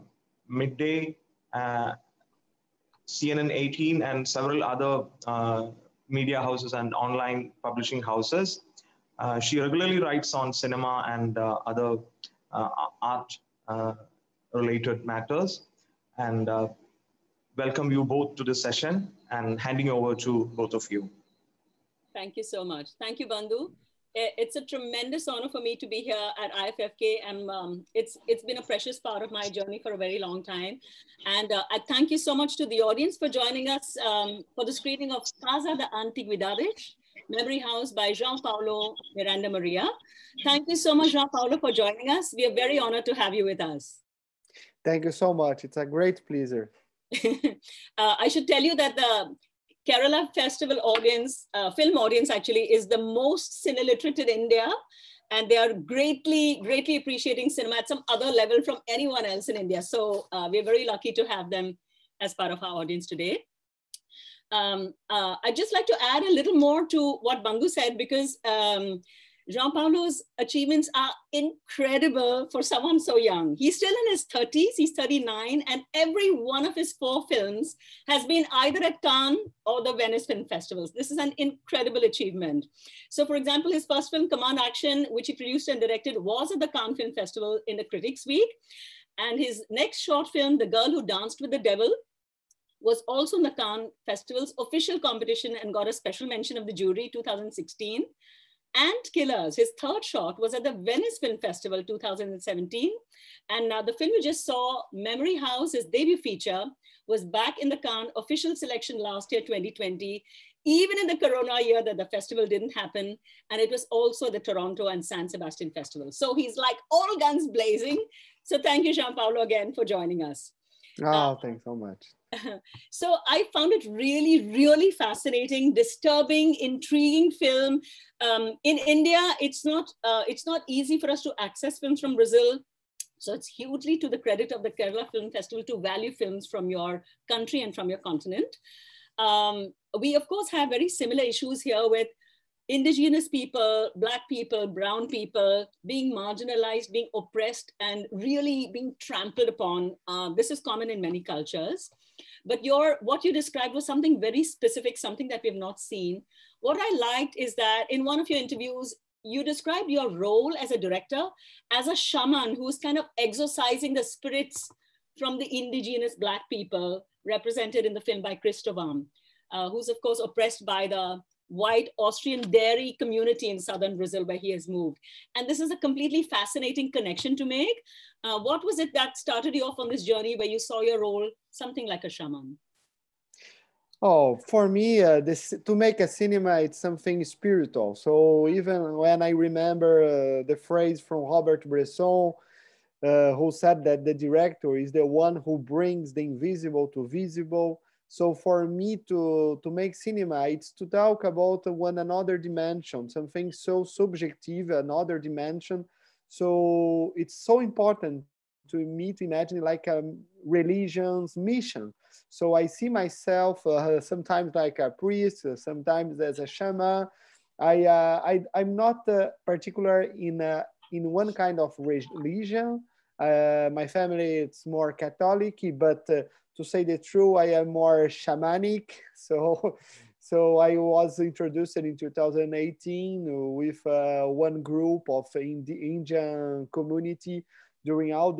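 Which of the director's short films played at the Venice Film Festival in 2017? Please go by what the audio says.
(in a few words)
Ant Killers.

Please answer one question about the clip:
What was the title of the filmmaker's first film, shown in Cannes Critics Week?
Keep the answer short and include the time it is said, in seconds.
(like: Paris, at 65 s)
Command Action, at 84 s.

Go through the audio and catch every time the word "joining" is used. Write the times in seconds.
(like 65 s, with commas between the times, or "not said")
33 s, 41 s, 119 s.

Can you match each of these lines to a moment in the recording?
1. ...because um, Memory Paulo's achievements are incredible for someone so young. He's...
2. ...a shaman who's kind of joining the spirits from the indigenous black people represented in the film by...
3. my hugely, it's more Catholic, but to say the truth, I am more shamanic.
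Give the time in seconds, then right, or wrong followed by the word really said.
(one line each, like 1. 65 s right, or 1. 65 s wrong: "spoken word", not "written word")
1. 67 s wrong: "João", not "Memory"
2. 161 s wrong: "exorcising", not "joining"
3. 223 s wrong: "family", not "hugely".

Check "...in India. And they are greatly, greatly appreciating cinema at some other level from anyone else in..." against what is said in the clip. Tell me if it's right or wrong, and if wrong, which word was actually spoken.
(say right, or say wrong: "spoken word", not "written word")
right.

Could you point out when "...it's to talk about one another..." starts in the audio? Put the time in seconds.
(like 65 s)
200 s.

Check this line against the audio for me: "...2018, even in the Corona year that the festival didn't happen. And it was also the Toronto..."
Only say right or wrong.
wrong.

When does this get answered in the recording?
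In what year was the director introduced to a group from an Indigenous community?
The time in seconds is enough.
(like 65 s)
231 s.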